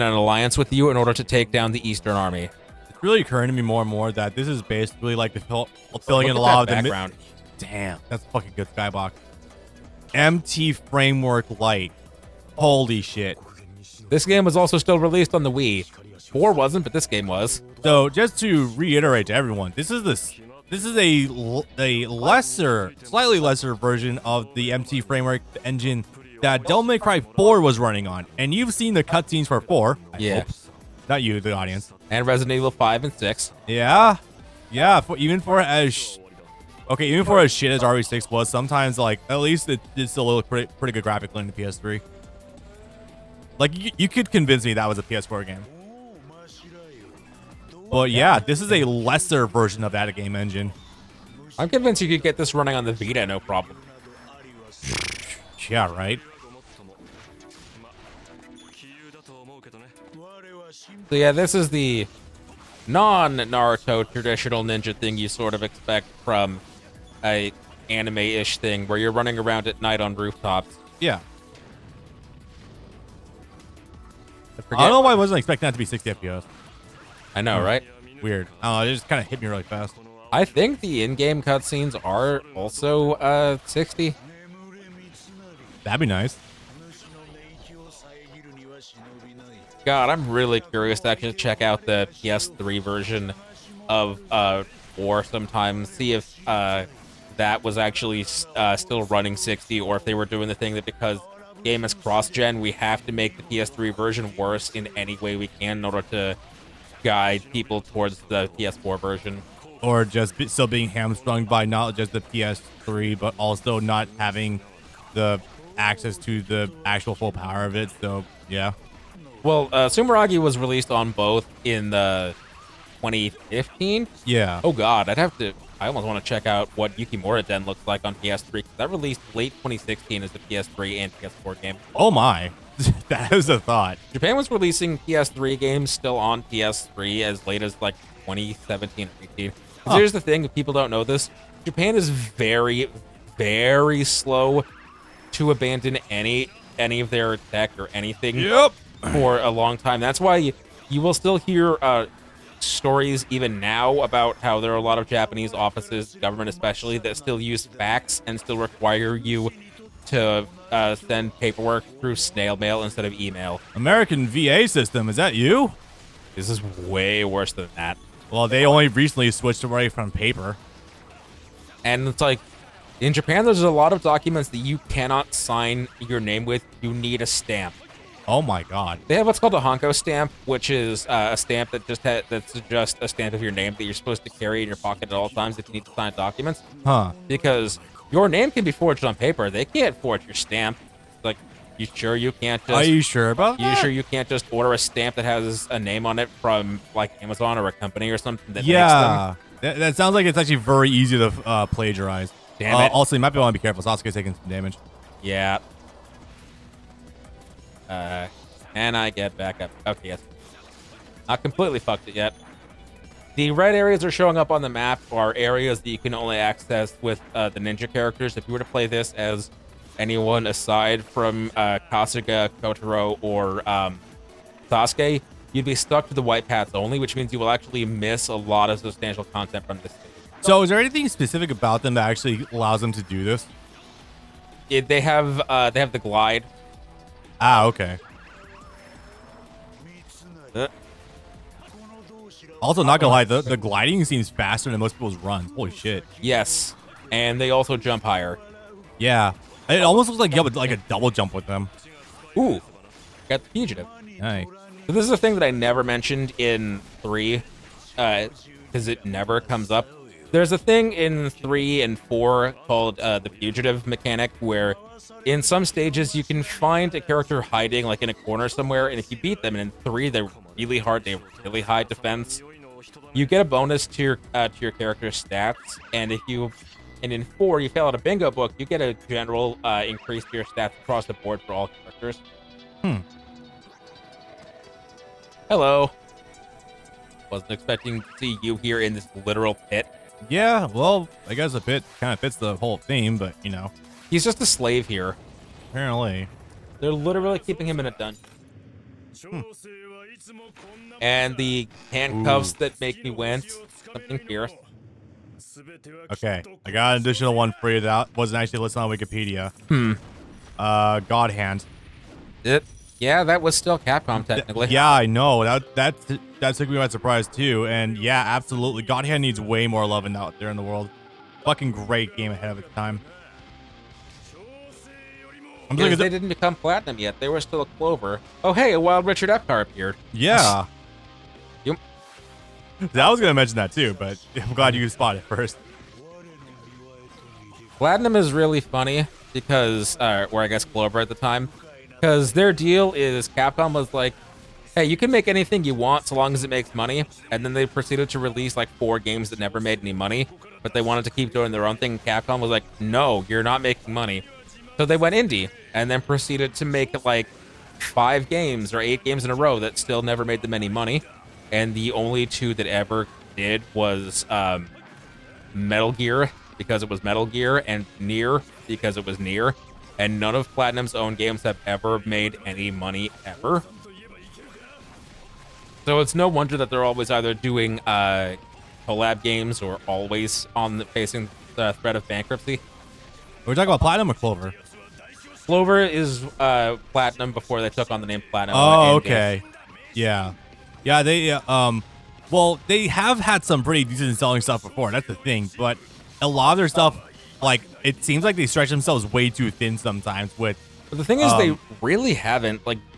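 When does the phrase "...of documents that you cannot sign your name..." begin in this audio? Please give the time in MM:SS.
02:53.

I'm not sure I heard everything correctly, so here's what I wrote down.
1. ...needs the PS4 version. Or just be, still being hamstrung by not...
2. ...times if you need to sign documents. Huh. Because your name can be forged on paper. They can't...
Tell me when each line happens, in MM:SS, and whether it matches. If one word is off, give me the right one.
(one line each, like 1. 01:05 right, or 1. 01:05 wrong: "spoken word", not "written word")
1. 01:47 wrong: "towards", not "needs"
2. 03:05 right.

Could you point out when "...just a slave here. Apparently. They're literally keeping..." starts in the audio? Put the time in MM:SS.
04:54.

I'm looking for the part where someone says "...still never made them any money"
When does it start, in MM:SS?
05:59.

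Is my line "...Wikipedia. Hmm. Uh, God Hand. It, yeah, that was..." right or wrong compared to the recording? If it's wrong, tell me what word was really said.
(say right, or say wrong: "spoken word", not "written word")
right.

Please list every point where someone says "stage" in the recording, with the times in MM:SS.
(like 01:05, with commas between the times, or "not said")
03:49, 04:25.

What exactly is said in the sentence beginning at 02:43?
American VA system, is that you?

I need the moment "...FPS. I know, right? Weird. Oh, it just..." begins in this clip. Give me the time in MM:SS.
01:16.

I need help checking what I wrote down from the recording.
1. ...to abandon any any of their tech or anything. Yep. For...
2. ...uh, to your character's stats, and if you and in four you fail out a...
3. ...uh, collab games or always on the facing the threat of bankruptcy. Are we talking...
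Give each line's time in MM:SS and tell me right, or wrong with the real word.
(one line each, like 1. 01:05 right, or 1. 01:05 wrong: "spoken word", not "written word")
1. 02:25 right
2. 04:34 right
3. 06:17 right.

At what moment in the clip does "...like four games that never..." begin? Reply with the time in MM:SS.
05:48.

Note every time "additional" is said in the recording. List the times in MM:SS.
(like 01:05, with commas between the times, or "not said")
05:07.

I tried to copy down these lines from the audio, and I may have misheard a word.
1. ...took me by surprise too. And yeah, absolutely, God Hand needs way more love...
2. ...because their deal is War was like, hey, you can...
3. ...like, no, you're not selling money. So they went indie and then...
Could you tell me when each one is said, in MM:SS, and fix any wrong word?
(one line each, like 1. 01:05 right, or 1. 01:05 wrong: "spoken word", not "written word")
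1. 05:16 right
2. 05:41 wrong: "Capcom", not "War"
3. 05:52 wrong: "making", not "selling".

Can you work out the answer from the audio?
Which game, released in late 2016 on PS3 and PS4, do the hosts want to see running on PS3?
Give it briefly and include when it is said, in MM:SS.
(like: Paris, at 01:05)
Yukimura Den, at 02:06.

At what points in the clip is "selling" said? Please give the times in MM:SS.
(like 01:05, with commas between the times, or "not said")
06:34.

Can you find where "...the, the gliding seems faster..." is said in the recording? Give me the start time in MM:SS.
04:03.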